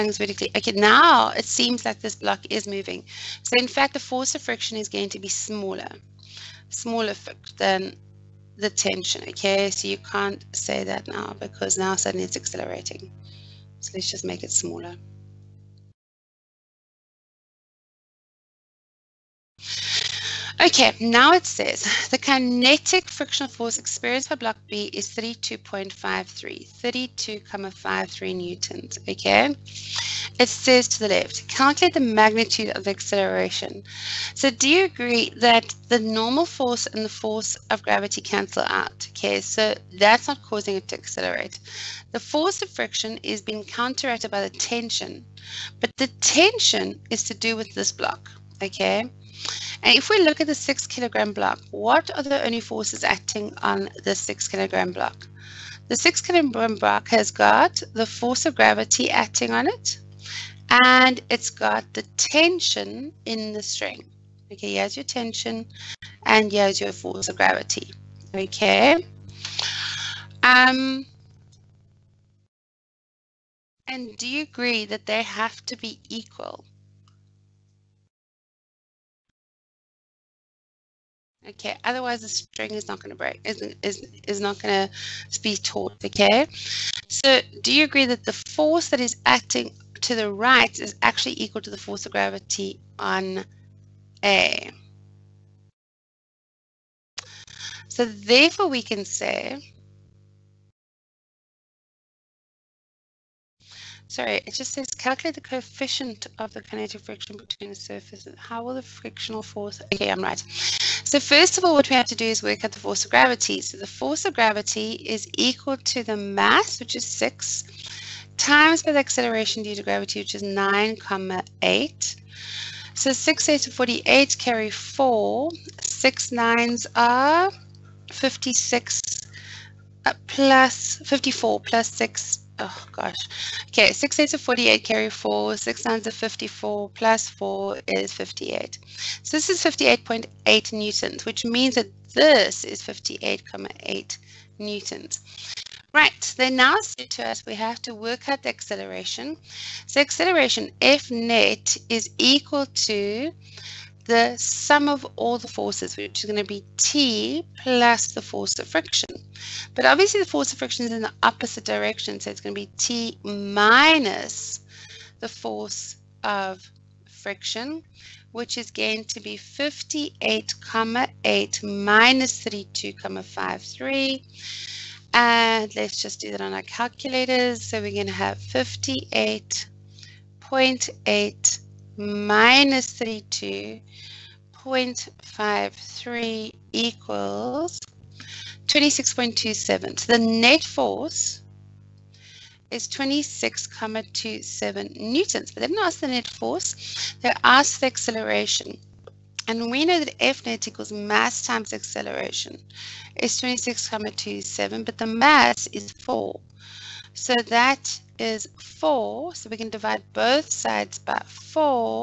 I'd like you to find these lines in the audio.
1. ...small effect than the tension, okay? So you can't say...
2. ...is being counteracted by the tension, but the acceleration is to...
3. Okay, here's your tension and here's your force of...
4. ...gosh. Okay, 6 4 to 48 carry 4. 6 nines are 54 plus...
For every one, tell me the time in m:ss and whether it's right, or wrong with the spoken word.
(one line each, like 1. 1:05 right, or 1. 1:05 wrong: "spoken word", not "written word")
1. 0:06 right
2. 0:43 wrong: "tension", not "acceleration"
3. 1:04 right
4. 2:12 wrong: "8", not "4".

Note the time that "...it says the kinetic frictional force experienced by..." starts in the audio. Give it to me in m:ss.
0:21.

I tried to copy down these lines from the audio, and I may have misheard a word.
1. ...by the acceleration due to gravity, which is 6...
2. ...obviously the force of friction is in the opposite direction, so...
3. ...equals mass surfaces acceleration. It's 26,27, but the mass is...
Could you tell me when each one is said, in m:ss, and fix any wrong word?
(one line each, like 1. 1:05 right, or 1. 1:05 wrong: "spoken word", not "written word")
1. 1:58 wrong: "9", not "6"
2. 2:39 right
3. 3:20 wrong: "times", not "surfaces".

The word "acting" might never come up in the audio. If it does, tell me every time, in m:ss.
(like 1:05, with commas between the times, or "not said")
0:53, 0:59, 1:29.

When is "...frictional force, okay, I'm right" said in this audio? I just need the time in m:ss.
1:48.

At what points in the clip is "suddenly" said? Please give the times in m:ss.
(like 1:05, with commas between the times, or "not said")
0:11.